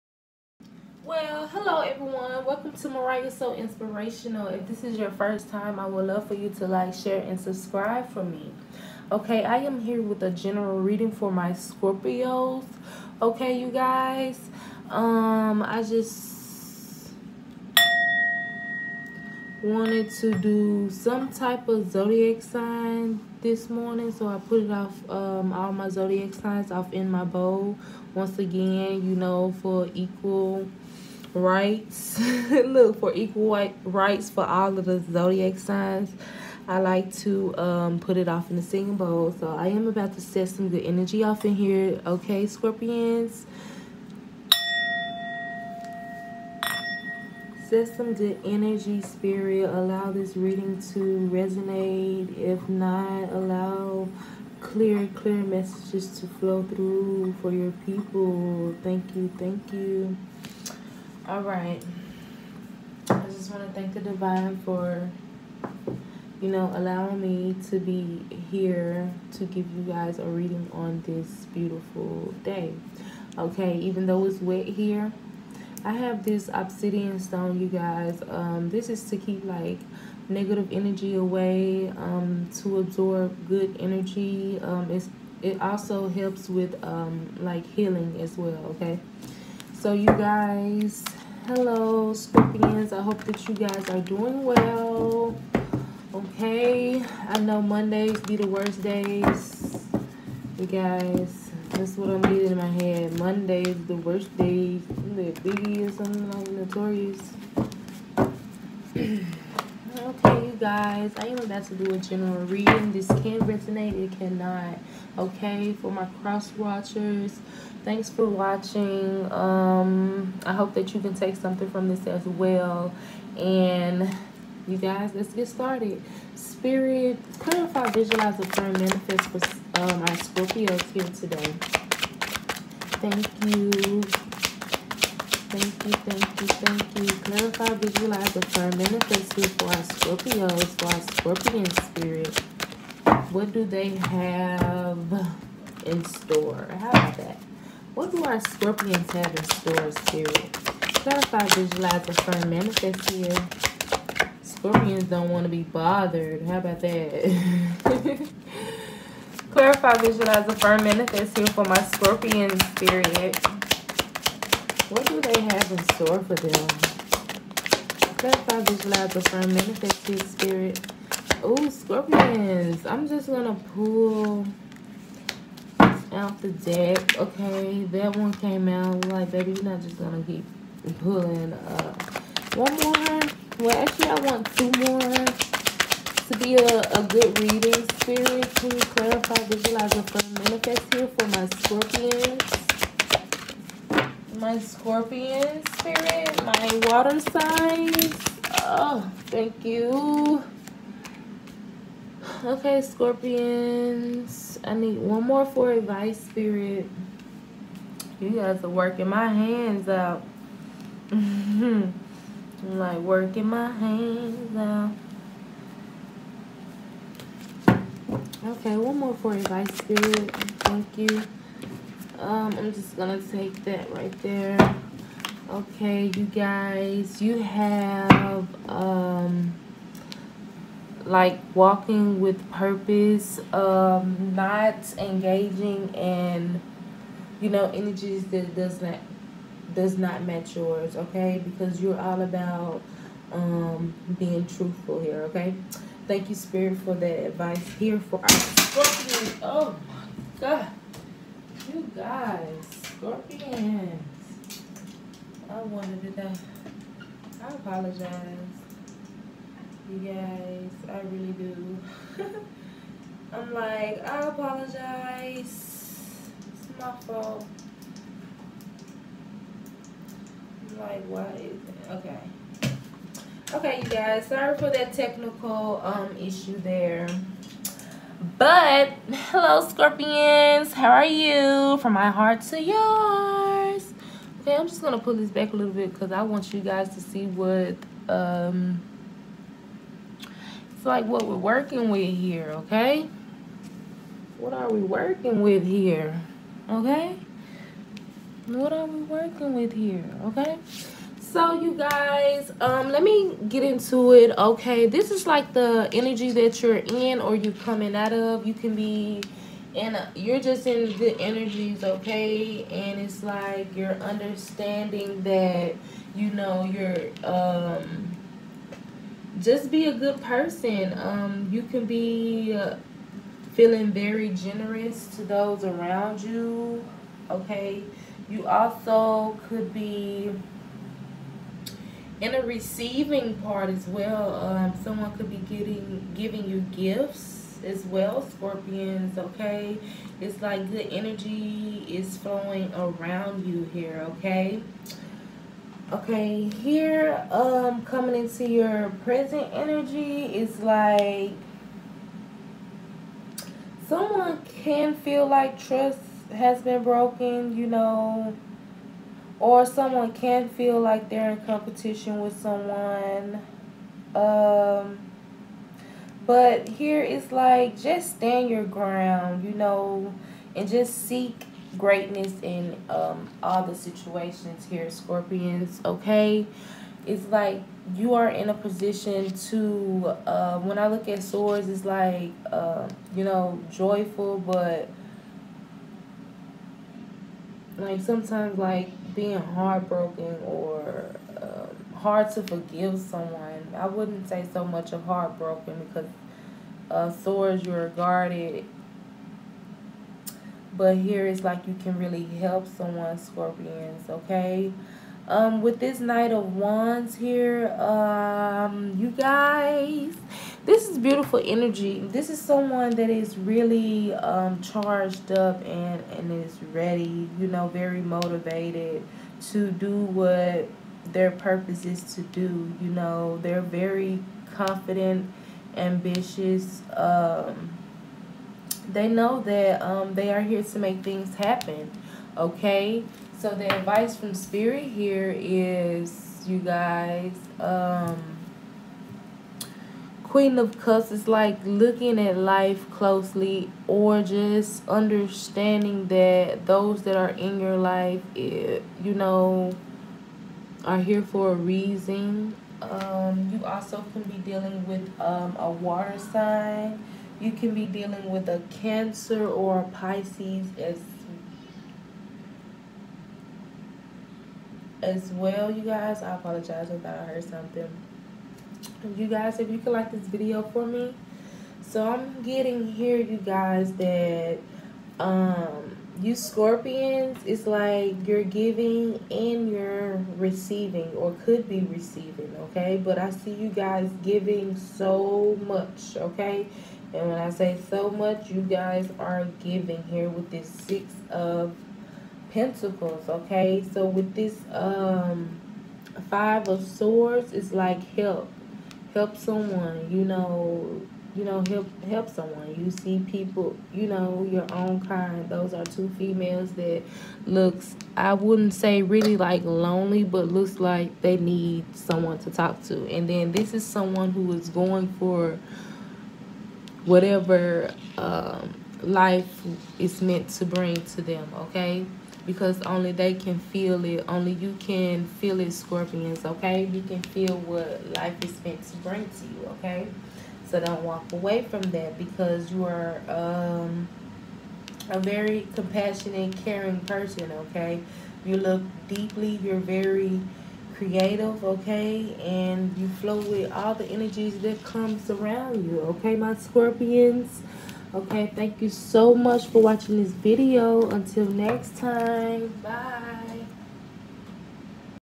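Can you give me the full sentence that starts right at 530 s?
So don't walk away from that because you are um, a very compassionate, caring person, okay?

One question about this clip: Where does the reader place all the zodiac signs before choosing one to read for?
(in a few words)
singing bowl.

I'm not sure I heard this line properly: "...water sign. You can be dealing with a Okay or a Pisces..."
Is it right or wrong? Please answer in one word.
wrong.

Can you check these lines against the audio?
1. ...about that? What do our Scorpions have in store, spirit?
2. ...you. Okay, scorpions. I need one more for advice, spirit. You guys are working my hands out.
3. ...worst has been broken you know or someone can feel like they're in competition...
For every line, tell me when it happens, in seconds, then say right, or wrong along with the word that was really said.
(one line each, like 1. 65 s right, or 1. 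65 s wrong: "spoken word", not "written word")
1. 146 s right
2. 199 s right
3. 355 s wrong: "trust", not "worst".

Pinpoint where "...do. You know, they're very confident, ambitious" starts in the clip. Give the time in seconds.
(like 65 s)
422 s.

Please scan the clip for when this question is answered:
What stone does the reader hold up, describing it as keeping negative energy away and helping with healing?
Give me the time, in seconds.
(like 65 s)
76 s.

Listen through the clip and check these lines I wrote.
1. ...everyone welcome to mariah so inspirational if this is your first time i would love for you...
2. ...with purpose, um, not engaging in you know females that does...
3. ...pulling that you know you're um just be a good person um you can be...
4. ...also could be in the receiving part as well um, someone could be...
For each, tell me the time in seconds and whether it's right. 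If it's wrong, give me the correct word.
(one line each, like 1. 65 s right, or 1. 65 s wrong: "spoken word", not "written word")
1. 1 s right
2. 232 s wrong: "energies", not "females"
3. 314 s wrong: "understanding", not "pulling"
4. 328 s right.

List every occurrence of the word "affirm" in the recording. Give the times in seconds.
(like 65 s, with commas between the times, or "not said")
128 s, 138 s, 152 s, 160 s, 169 s, 189 s.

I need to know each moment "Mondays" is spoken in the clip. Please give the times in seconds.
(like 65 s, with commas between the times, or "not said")
97 s, 103 s.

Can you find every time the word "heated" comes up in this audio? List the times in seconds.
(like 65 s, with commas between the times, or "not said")
not said.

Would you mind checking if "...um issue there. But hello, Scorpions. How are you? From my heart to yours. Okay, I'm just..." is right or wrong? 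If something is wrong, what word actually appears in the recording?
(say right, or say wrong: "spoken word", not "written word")
right.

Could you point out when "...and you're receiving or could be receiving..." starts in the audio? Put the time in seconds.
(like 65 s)
479 s.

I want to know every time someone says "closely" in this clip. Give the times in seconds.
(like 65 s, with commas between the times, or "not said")
442 s.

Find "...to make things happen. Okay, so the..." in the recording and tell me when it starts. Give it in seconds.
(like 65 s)
430 s.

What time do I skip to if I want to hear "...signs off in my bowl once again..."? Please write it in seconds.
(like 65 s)
26 s.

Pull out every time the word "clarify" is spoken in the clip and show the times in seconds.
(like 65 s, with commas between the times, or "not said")
127 s, 137 s, 150 s, 159 s, 168 s, 188 s.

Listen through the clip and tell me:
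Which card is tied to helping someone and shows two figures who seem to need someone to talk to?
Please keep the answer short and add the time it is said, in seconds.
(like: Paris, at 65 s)
Five of Swords, at 496 s.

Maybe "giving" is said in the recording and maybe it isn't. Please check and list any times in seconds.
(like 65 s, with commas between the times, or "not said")
336 s, 478 s, 484 s, 489 s.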